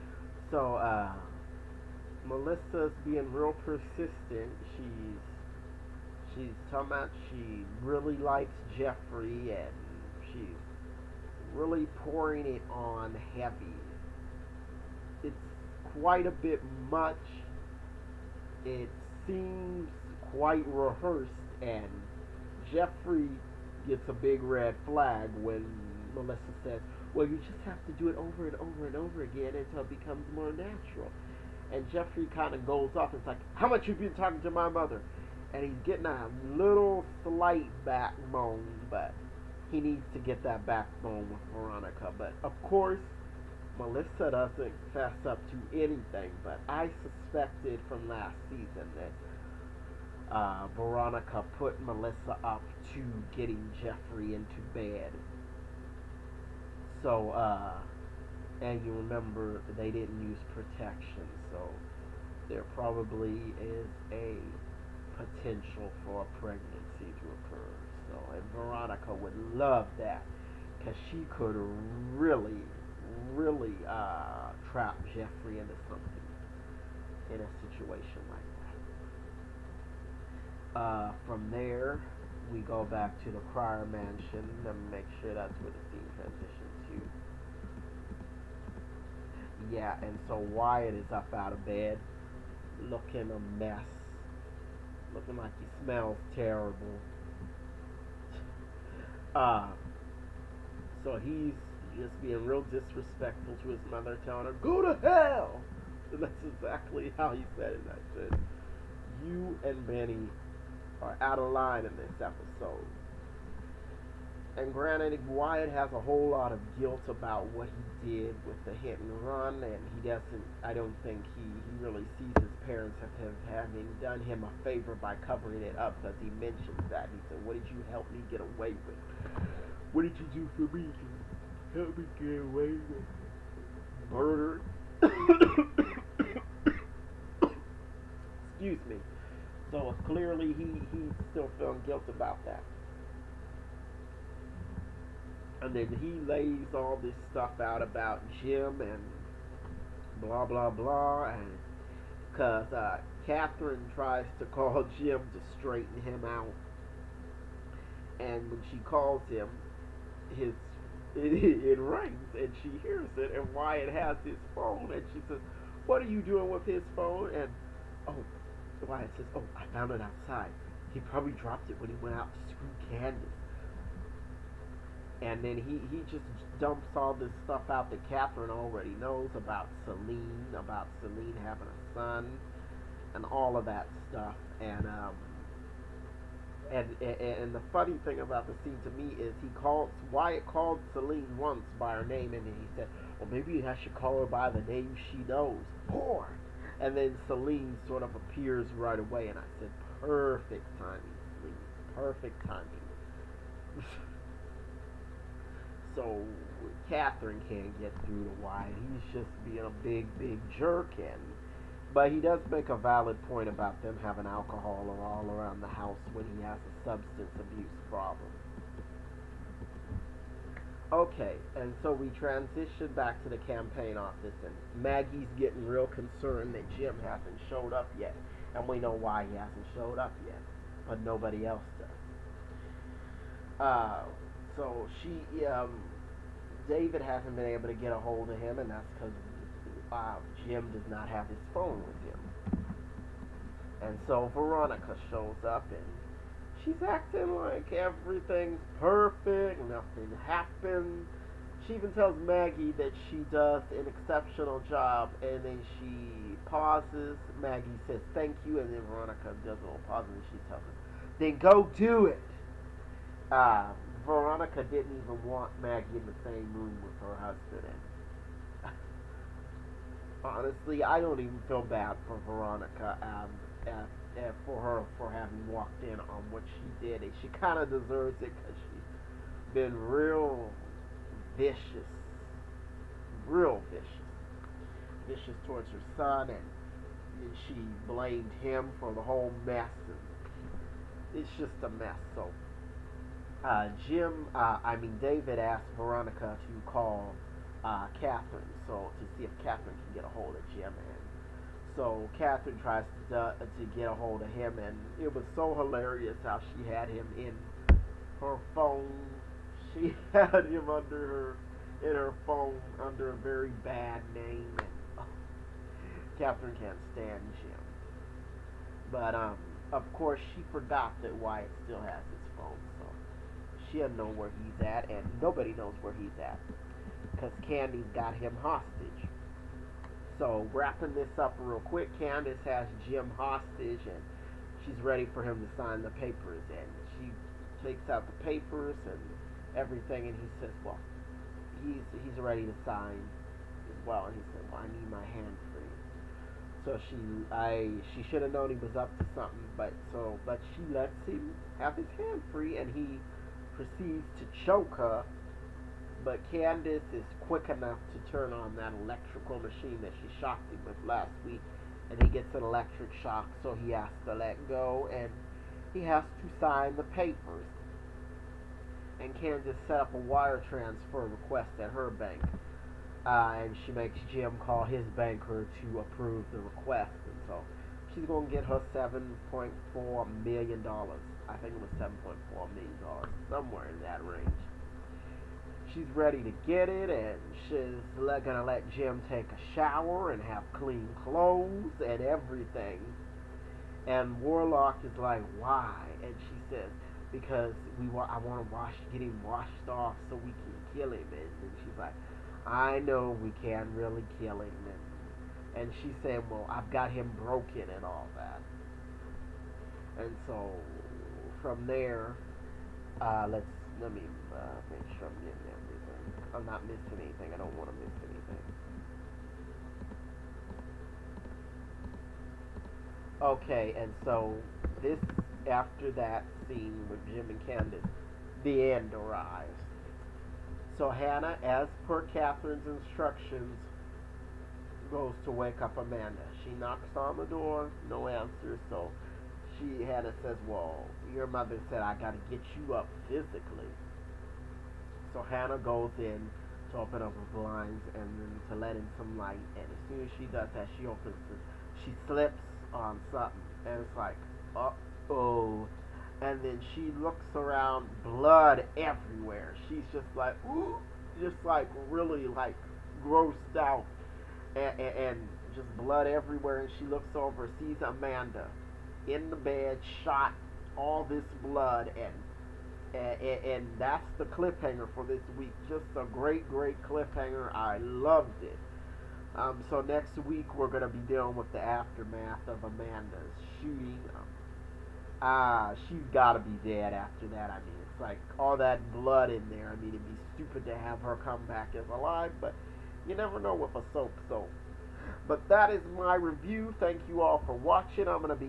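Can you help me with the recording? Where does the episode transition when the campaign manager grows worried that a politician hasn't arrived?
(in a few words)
campaign office.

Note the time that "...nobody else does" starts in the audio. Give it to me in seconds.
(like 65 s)
231 s.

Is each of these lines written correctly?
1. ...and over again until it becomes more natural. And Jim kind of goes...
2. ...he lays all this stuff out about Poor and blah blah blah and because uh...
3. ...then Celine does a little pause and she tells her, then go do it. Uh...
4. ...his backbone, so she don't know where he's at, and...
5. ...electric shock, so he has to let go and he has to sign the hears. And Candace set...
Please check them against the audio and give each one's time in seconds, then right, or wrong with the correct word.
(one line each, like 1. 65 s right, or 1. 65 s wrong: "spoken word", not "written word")
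1. 28 s wrong: "Jeffrey", not "Jim"
2. 146 s wrong: "Jim", not "Poor"
3. 258 s wrong: "Veronica", not "Celine"
4. 322 s wrong: "phone", not "backbone"
5. 362 s wrong: "papers", not "hears".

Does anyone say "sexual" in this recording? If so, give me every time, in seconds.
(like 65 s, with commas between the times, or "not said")
not said.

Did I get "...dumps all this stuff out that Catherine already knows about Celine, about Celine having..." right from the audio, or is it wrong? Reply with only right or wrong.
right.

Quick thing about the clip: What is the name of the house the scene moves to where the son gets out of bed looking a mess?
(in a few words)
Cryer Mansion.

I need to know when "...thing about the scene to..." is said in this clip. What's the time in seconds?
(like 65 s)
188 s.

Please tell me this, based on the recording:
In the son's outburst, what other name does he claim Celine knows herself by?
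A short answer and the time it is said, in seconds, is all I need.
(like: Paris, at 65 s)
Poor, at 195 s.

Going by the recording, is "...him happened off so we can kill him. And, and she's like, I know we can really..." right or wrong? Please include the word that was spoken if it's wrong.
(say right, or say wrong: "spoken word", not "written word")
wrong: "washed", not "happened".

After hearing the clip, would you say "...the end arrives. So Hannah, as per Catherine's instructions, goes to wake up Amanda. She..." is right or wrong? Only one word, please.
right.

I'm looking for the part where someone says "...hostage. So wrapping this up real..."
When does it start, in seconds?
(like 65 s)
328 s.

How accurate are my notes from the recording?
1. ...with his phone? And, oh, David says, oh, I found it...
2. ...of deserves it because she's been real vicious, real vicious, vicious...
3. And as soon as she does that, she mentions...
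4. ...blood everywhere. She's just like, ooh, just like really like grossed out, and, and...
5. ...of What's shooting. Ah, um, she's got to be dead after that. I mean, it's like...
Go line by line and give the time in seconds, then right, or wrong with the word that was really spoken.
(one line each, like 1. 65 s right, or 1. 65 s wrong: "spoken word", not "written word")
1. 166 s wrong: "Wyatt", not "David"
2. 277 s right
3. 449 s wrong: "opens", not "mentions"
4. 458 s right
5. 482 s wrong: "Amanda", not "What".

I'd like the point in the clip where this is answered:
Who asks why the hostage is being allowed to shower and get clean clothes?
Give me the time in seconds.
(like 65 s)
394 s.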